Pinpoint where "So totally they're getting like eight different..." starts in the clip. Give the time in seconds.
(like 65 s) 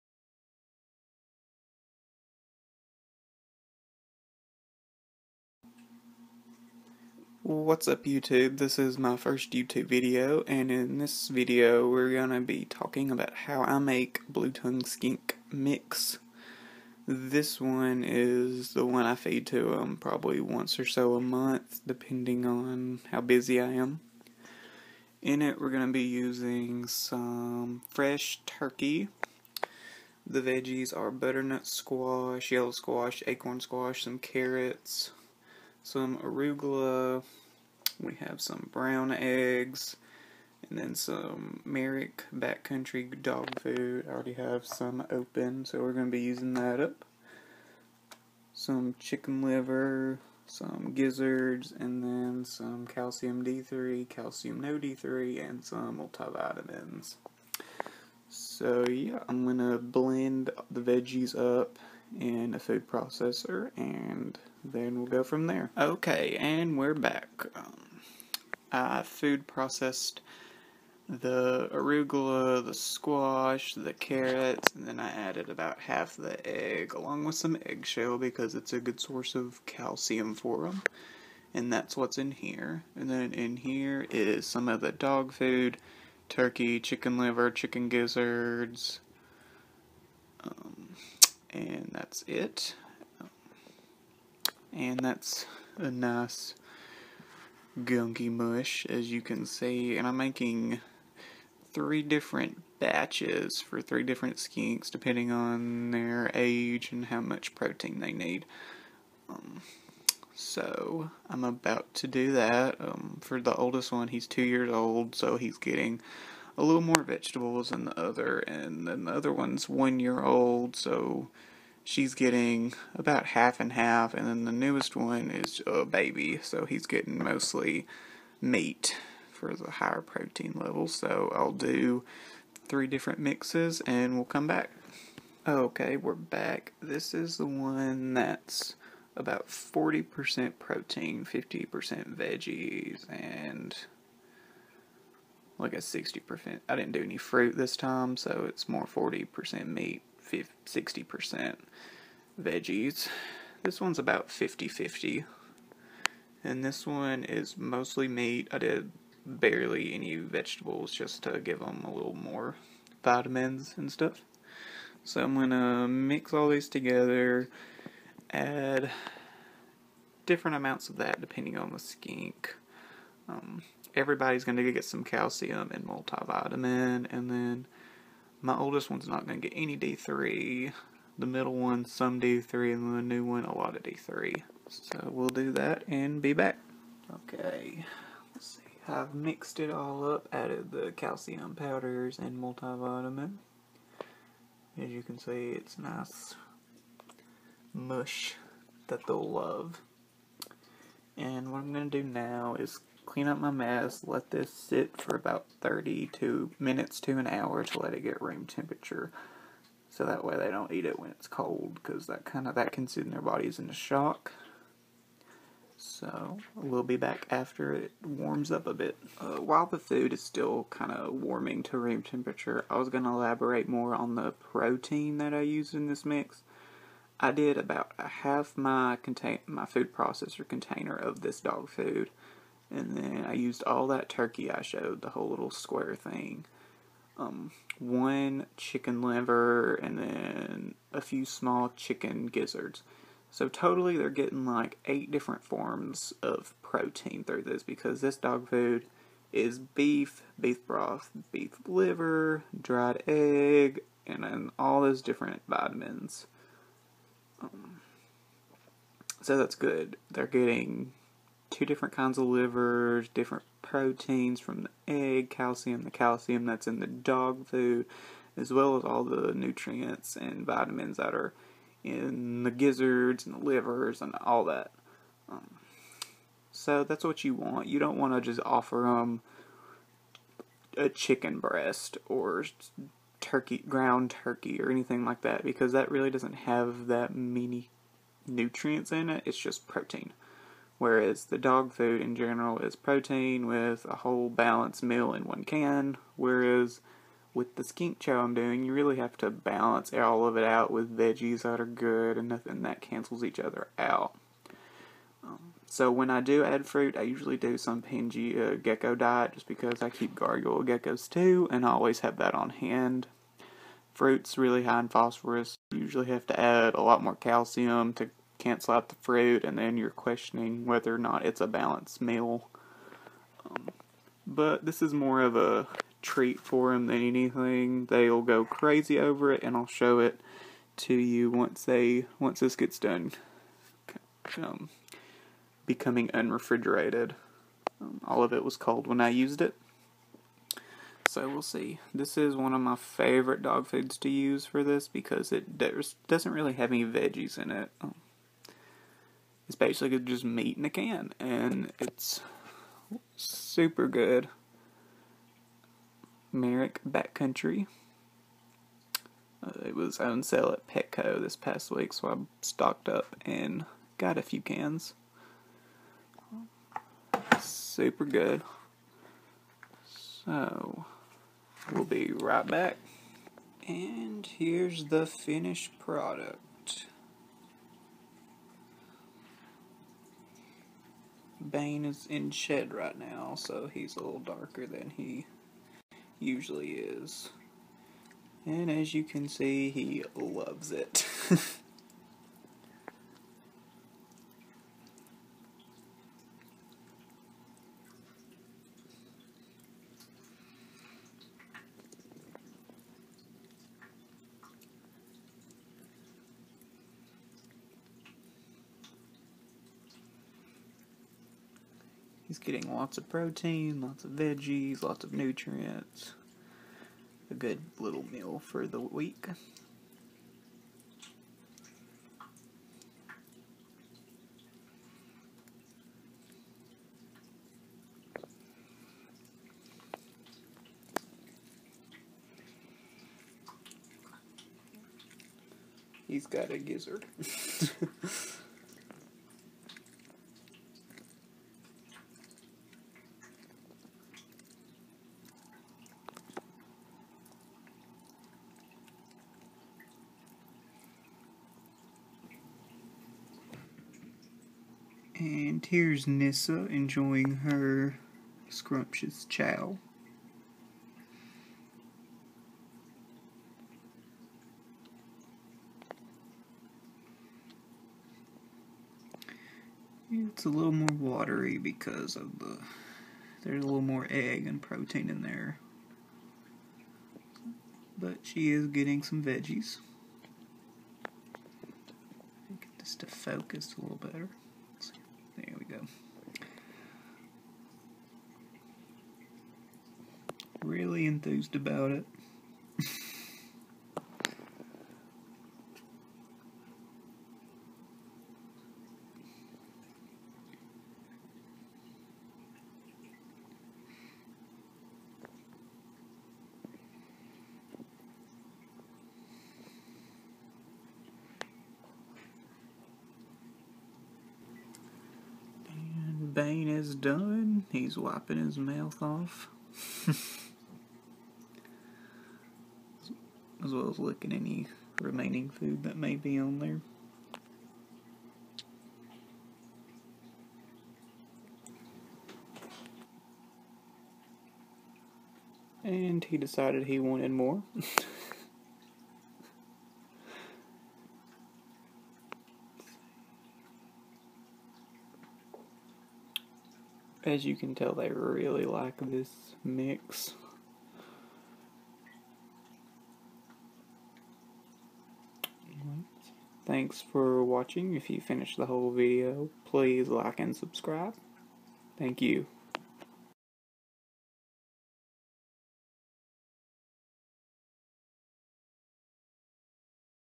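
243 s.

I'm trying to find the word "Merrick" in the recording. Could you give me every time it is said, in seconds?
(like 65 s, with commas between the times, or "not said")
41 s, 356 s.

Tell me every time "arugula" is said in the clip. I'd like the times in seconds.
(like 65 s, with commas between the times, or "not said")
36 s, 71 s.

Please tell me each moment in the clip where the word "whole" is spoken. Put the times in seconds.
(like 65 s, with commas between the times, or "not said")
235 s, 293 s, 558 s.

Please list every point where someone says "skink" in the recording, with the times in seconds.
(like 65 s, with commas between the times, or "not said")
14 s, 104 s, 171 s, 297 s.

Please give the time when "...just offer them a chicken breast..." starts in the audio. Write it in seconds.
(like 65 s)
278 s.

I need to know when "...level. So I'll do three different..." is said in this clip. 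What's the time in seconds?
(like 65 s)
130 s.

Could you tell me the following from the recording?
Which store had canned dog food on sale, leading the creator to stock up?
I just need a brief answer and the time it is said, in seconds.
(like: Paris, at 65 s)
Petco, at 360 s.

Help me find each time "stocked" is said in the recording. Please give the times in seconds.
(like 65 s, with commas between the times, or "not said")
362 s.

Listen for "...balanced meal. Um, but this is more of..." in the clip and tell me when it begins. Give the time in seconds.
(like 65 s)
321 s.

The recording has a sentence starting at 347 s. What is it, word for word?
Um, it's basically just meat in a can, and it's super good.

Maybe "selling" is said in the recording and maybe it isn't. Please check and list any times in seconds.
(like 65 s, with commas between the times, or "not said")
not said.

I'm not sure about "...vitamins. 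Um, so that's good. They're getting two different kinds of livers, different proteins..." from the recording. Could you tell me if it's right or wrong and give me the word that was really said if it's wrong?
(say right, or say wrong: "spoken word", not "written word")
right.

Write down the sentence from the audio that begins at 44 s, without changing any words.
I already have some open, so we're going to be using that up.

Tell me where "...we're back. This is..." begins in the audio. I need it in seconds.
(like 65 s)
135 s.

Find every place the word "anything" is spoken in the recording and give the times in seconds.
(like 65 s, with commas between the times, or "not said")
284 s, 327 s.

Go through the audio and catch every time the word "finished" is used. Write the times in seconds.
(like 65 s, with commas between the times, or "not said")
375 s, 558 s.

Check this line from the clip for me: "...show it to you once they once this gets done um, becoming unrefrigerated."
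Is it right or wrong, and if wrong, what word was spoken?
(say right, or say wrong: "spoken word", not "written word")
right.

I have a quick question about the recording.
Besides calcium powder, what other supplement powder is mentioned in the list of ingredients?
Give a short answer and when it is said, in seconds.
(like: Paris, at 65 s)
multivitamins, at 55 s.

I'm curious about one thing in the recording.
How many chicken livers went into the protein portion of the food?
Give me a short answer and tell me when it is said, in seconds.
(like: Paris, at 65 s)
1, at 237 s.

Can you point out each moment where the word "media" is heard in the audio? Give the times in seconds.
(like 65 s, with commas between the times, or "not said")
not said.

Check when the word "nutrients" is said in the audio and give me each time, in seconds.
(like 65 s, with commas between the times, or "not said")
269 s, 288 s, 415 s.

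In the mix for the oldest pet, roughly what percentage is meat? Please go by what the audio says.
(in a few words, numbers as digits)
40%.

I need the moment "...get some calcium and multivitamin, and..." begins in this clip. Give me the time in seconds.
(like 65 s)
174 s.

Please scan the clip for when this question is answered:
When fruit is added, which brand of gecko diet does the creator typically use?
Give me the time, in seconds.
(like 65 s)
307 s.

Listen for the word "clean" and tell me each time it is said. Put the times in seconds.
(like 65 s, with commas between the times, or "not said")
203 s.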